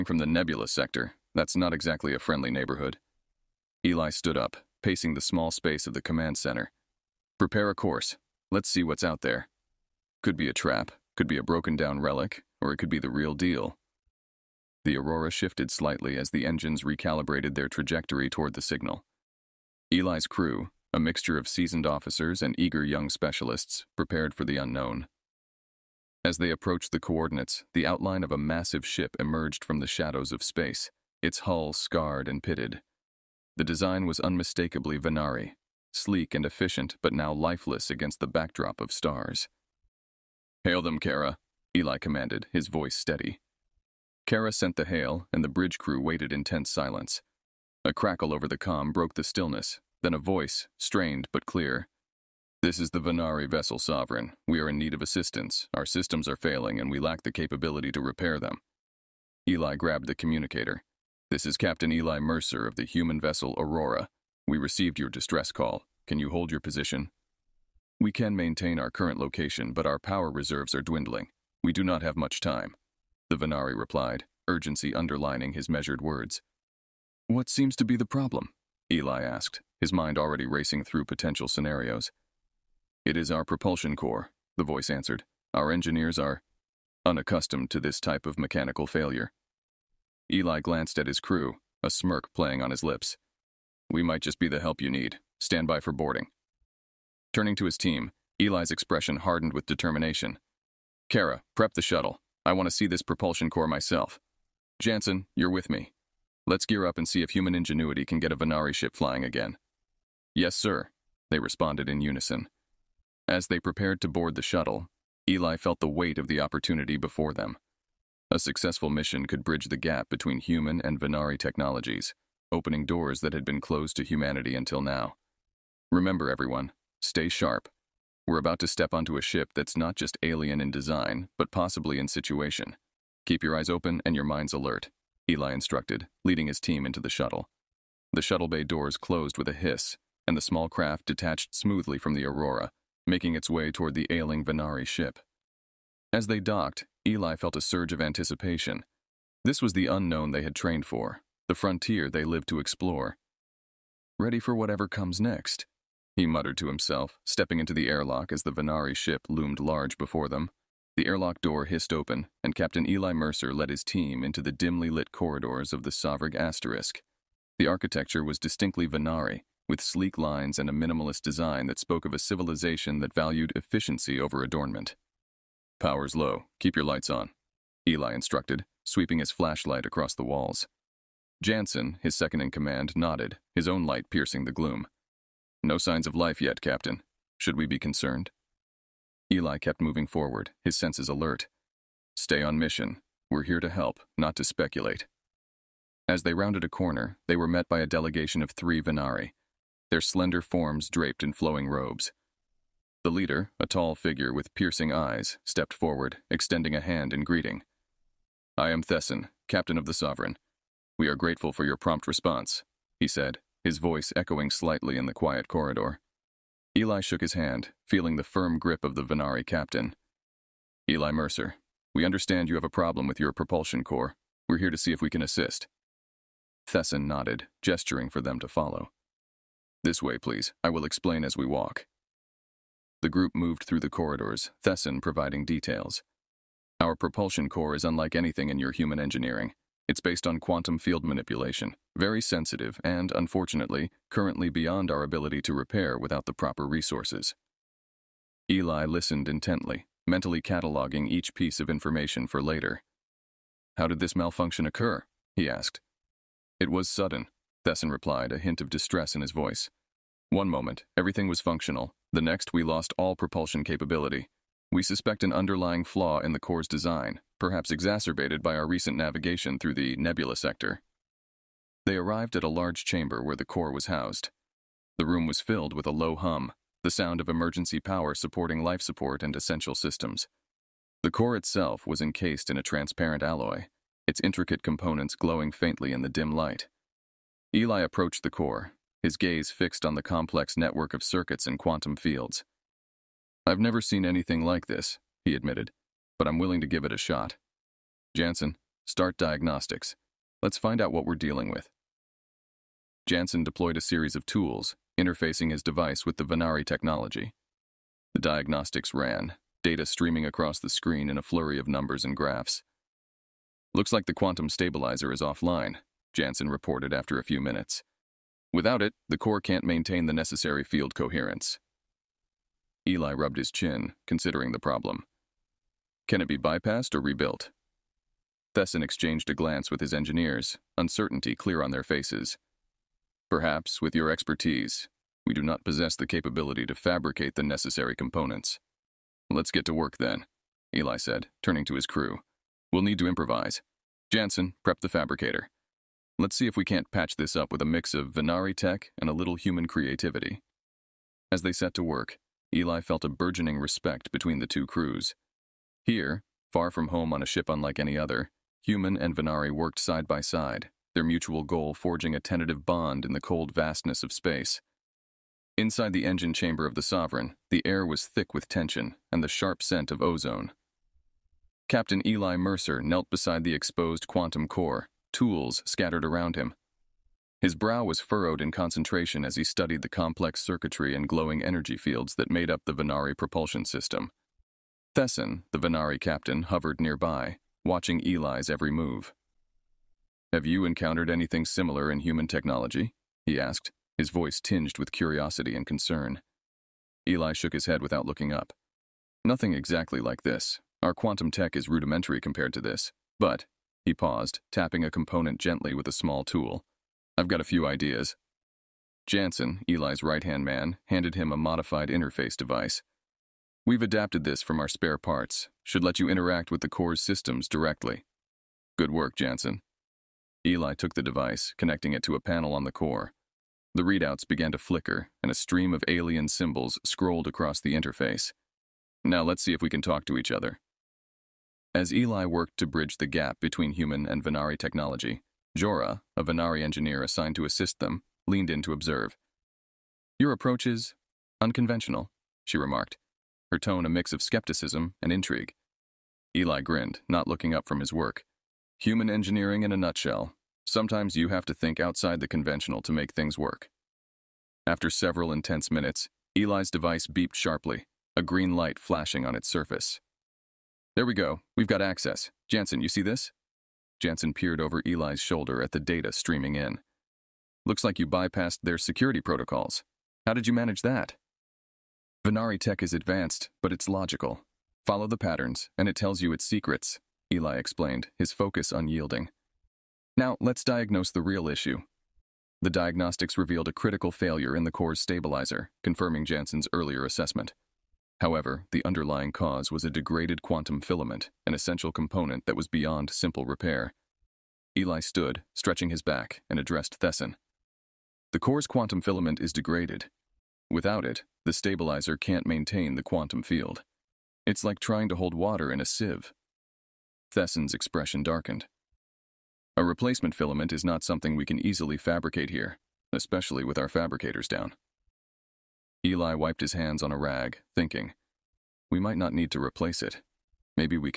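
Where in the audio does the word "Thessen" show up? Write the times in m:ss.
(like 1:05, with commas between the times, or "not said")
3:28, 3:46, 3:54, 4:17, 5:28, 6:24, 8:17, 8:27.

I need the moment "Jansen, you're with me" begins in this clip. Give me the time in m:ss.
1:44.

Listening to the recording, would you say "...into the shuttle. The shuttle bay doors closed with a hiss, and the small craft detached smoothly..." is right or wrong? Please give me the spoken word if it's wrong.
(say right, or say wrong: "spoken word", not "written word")
right.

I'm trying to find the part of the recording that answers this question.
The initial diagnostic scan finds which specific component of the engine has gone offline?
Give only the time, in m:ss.
5:14.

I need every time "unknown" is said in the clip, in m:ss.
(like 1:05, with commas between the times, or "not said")
0:24, 2:29.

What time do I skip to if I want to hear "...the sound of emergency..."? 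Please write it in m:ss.
4:36.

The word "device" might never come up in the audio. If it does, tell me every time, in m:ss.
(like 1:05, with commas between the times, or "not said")
5:05, 6:52, 7:01, 7:36.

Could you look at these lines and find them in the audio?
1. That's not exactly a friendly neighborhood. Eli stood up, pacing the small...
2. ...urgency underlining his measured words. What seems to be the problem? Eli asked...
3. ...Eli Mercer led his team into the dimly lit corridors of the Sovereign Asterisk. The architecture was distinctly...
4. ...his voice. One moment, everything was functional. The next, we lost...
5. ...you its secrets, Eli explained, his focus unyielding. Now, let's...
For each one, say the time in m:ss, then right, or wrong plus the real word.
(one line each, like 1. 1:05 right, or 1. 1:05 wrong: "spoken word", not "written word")
1. 0:01 right
2. 1:14 right
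3. 2:42 right
4. 4:19 right
5. 7:56 right.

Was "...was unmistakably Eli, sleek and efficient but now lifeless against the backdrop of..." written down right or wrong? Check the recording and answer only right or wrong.
wrong.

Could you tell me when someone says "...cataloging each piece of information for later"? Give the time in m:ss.
4:10.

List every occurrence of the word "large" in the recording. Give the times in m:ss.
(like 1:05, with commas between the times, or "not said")
2:39, 4:32.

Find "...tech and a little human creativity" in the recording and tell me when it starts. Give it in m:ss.
5:48.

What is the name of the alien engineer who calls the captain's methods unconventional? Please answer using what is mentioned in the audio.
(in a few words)
Jora.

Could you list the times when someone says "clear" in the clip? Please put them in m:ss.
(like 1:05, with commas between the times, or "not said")
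0:51, 5:31.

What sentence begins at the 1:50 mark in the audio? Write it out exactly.
Yes, sir, they responded in unison.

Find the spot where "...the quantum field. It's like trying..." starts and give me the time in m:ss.
8:22.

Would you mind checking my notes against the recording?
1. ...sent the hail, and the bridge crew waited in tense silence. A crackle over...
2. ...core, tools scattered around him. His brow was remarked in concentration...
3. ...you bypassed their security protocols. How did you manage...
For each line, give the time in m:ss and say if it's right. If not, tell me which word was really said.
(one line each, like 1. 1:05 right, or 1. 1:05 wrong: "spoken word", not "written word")
1. 0:44 right
2. 6:14 wrong: "furrowed", not "remarked"
3. 7:47 right.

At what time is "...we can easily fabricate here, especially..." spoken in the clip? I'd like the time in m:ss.
8:31.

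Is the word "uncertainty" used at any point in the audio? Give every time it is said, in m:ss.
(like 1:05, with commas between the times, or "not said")
5:30.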